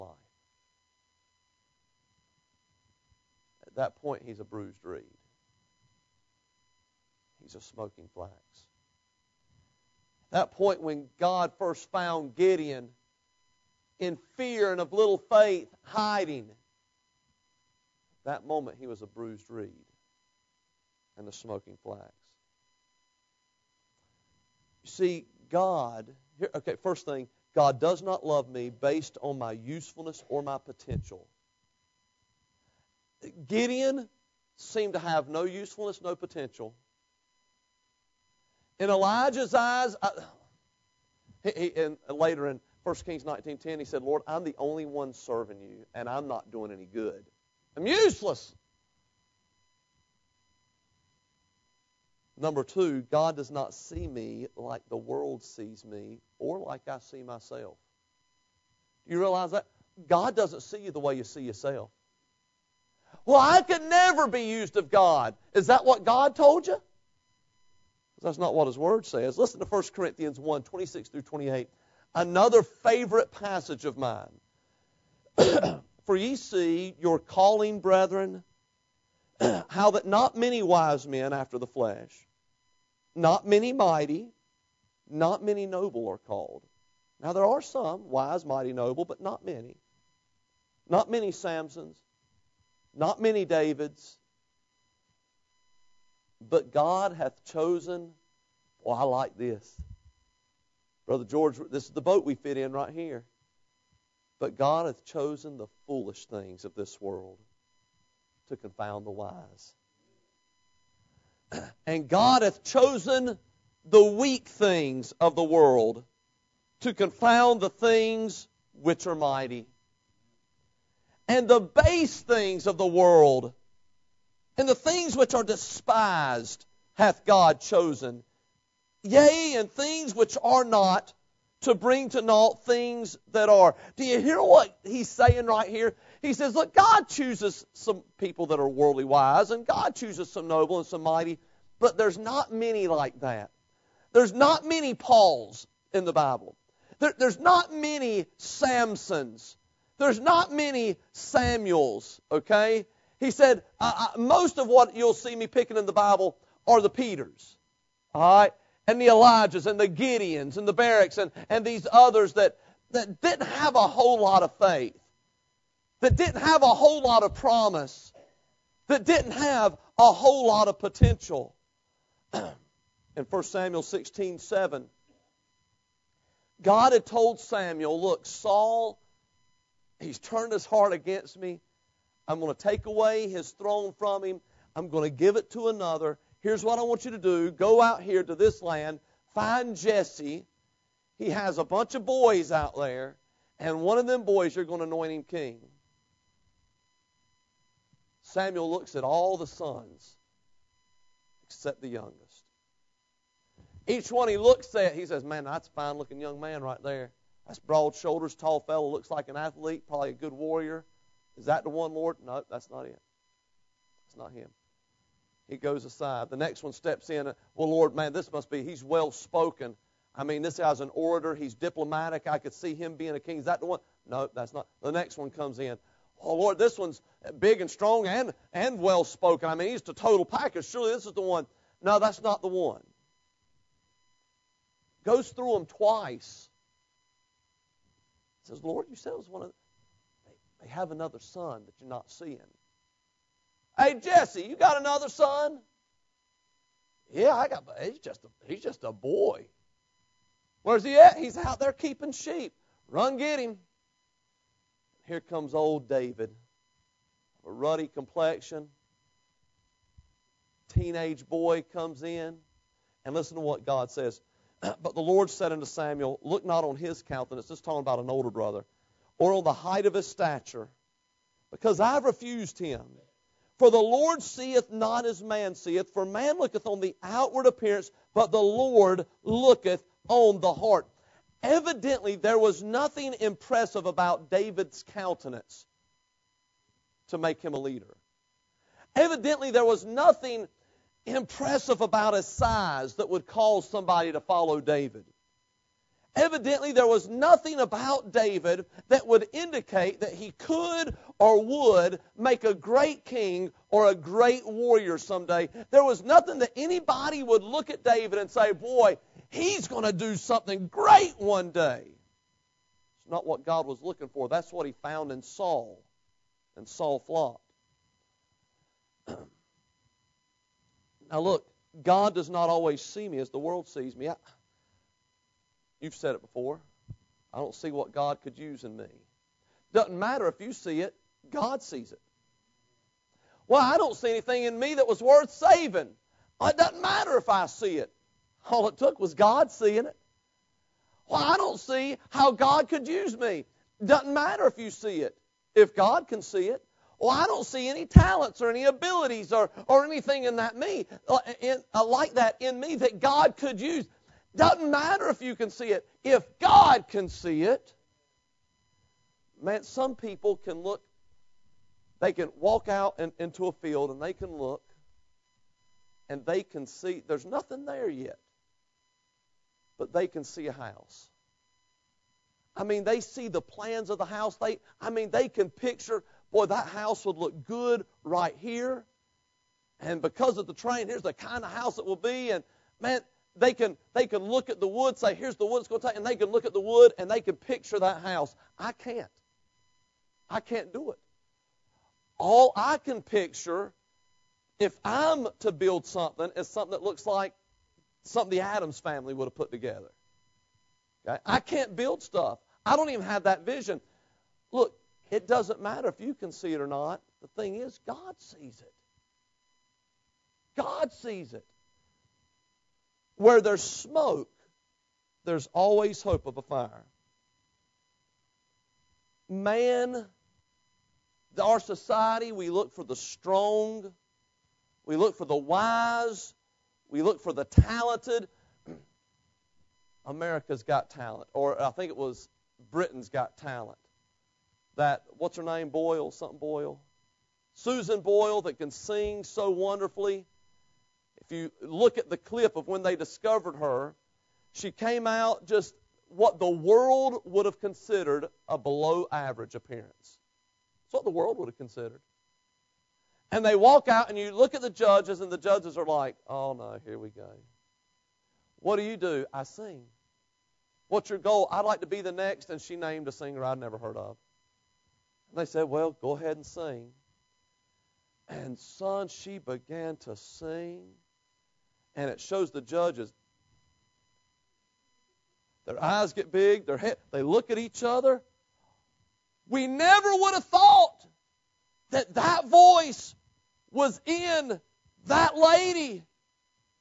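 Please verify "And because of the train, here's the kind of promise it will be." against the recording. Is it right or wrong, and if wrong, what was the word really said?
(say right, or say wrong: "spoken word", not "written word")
wrong: "house", not "promise".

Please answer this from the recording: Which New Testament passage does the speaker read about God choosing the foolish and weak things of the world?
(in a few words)
1 Corinthians 1:26-28.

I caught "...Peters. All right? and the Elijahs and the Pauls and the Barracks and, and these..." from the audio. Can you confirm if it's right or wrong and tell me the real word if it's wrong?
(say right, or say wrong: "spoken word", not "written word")
wrong: "Gideons", not "Pauls".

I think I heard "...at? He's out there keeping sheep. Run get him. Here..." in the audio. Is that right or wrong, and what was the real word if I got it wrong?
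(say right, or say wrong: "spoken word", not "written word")
right.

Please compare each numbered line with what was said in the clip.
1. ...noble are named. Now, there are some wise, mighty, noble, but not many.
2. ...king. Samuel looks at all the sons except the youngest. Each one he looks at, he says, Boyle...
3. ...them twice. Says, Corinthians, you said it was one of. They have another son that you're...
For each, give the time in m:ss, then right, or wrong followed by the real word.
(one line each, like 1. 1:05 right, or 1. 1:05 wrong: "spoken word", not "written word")
1. 1:25 wrong: "called", not "named"
2. 3:15 wrong: "Man", not "Boyle"
3. 3:55 wrong: "Lord", not "Corinthians".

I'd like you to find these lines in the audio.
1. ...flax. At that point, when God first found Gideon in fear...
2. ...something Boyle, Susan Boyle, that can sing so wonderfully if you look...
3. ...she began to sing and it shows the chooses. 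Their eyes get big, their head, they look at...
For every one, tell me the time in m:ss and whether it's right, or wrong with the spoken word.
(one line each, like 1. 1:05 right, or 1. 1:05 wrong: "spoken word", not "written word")
1. 0:08 right
2. 7:16 right
3. 7:49 wrong: "judges", not "chooses".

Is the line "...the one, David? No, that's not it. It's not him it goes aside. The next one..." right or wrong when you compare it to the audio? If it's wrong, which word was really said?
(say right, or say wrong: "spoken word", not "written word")
wrong: "Lord", not "David".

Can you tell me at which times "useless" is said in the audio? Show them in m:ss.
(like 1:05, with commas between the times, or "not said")
0:47.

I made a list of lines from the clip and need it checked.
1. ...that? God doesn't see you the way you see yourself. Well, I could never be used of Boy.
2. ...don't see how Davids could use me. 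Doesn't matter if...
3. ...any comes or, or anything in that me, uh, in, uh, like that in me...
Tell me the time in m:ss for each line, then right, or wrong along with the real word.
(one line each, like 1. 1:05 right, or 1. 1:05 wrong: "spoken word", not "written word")
1. 0:59 wrong: "God", not "Boy"
2. 5:41 wrong: "God", not "Davids"
3. 5:48 wrong: "abilities", not "comes".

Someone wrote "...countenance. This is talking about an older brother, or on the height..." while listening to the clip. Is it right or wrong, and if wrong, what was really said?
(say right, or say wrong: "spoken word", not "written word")
right.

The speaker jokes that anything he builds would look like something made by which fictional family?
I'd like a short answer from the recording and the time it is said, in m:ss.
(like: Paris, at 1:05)
the Addams family, at 6:38.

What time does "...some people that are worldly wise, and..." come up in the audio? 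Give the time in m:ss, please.
2:17.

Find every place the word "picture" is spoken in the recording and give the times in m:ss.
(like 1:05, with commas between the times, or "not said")
6:15, 6:27, 6:33.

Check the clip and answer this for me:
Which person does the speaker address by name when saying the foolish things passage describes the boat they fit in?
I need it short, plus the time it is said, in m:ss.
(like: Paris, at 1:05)
Brother George, at 1:41.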